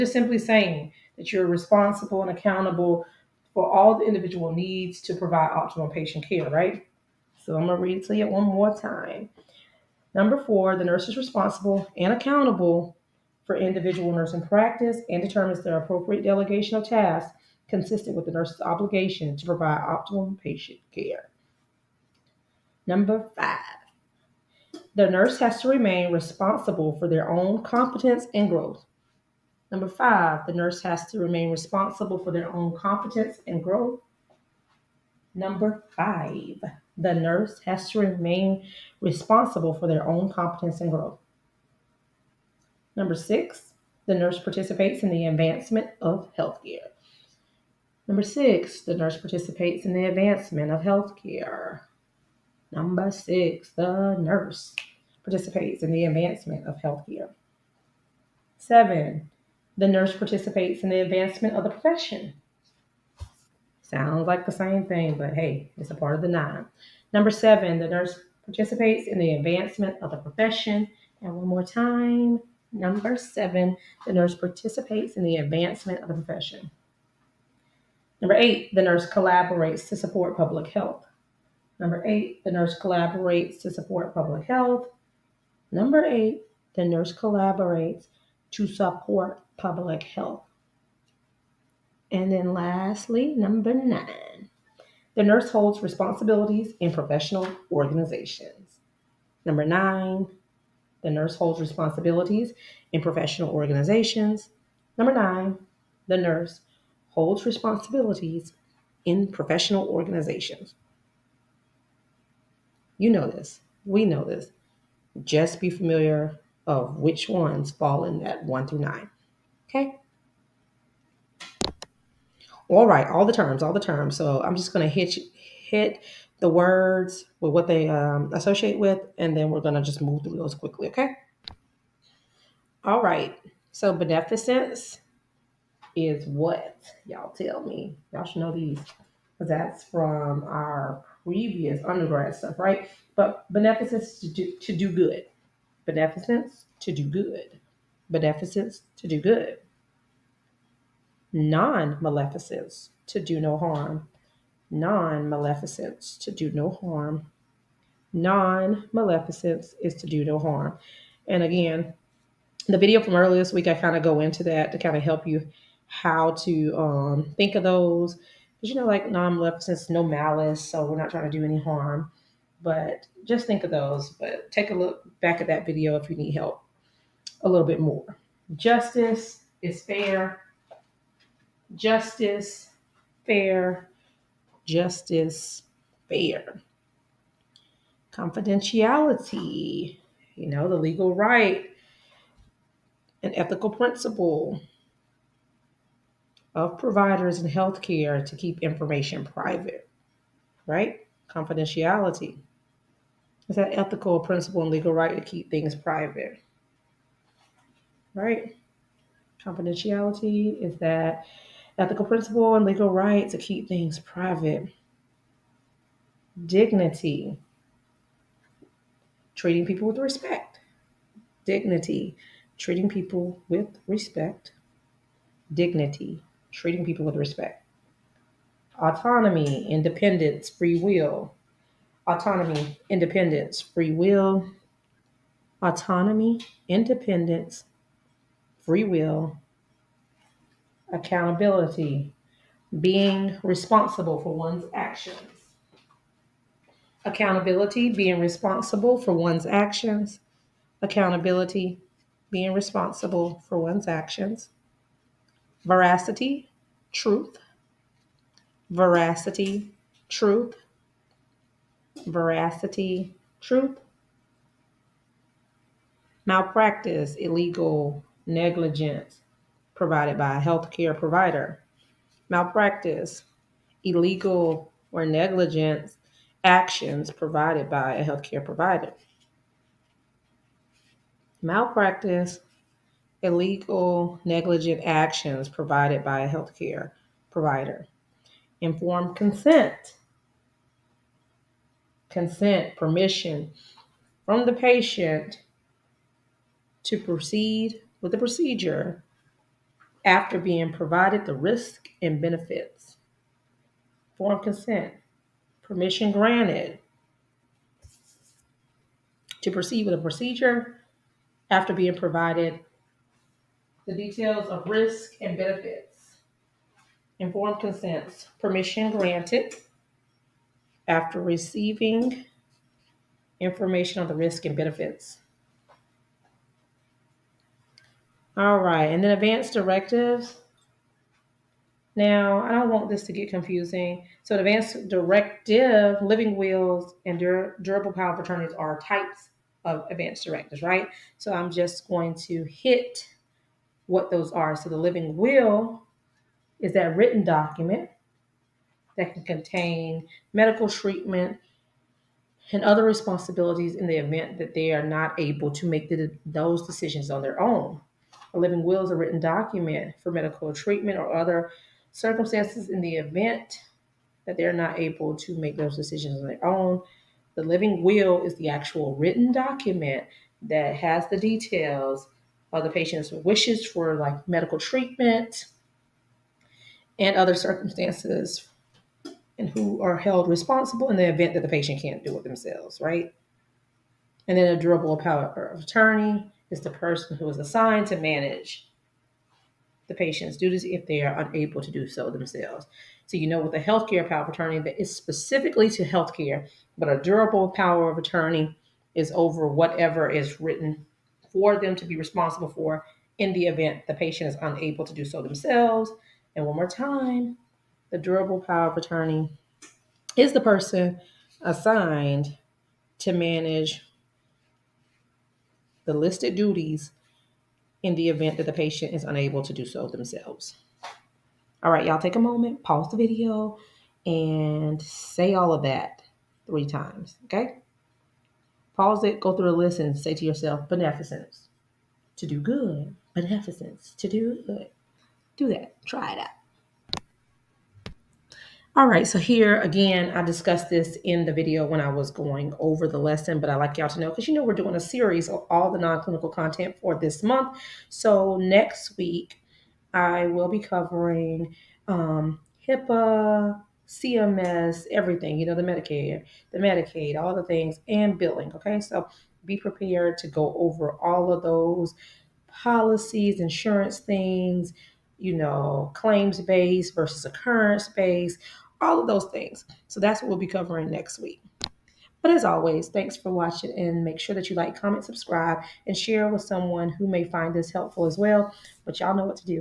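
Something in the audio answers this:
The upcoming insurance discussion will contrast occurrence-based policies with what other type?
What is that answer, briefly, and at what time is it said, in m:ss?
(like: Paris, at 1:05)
claims based, at 7:45.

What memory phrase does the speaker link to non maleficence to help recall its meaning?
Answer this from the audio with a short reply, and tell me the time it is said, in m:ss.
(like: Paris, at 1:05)
no malice, at 2:49.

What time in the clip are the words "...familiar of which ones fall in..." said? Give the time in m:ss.
1:55.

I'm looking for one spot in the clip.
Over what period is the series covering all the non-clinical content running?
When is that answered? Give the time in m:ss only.
7:26.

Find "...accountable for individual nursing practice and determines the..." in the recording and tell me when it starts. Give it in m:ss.
0:12.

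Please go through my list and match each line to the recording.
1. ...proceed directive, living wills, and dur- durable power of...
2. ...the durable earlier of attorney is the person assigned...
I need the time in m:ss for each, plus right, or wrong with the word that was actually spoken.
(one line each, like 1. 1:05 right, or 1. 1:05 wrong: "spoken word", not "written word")
1. 5:34 wrong: "advanced", not "proceed"
2. 6:47 wrong: "power", not "earlier".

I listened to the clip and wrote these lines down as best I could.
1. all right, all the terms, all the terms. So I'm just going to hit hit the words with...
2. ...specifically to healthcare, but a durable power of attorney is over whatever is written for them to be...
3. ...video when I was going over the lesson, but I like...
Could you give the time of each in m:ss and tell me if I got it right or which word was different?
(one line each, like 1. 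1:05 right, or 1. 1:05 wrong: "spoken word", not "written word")
1. 2:02 right
2. 6:34 right
3. 7:21 right.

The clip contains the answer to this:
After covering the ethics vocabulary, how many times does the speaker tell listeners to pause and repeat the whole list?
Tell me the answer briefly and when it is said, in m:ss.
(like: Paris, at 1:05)
3 times, at 7:06.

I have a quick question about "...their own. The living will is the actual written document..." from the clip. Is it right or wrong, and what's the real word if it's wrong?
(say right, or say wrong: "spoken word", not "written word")
right.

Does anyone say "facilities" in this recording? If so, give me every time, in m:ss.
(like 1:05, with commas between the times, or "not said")
not said.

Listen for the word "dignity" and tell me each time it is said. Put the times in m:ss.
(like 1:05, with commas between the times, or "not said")
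3:36, 3:41, 3:45.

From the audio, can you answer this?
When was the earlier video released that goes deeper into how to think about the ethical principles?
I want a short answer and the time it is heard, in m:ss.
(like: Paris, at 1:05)
earlier this week, at 2:43.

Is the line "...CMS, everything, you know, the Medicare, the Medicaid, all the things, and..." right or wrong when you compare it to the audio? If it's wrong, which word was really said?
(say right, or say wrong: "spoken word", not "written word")
right.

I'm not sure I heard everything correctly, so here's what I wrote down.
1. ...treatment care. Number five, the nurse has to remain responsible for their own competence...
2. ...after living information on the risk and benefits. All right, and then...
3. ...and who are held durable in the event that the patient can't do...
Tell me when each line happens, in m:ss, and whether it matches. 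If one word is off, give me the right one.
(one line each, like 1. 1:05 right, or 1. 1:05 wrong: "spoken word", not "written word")
1. 0:20 wrong: "patient", not "treatment"
2. 5:20 wrong: "receiving", not "living"
3. 6:19 wrong: "responsible", not "durable".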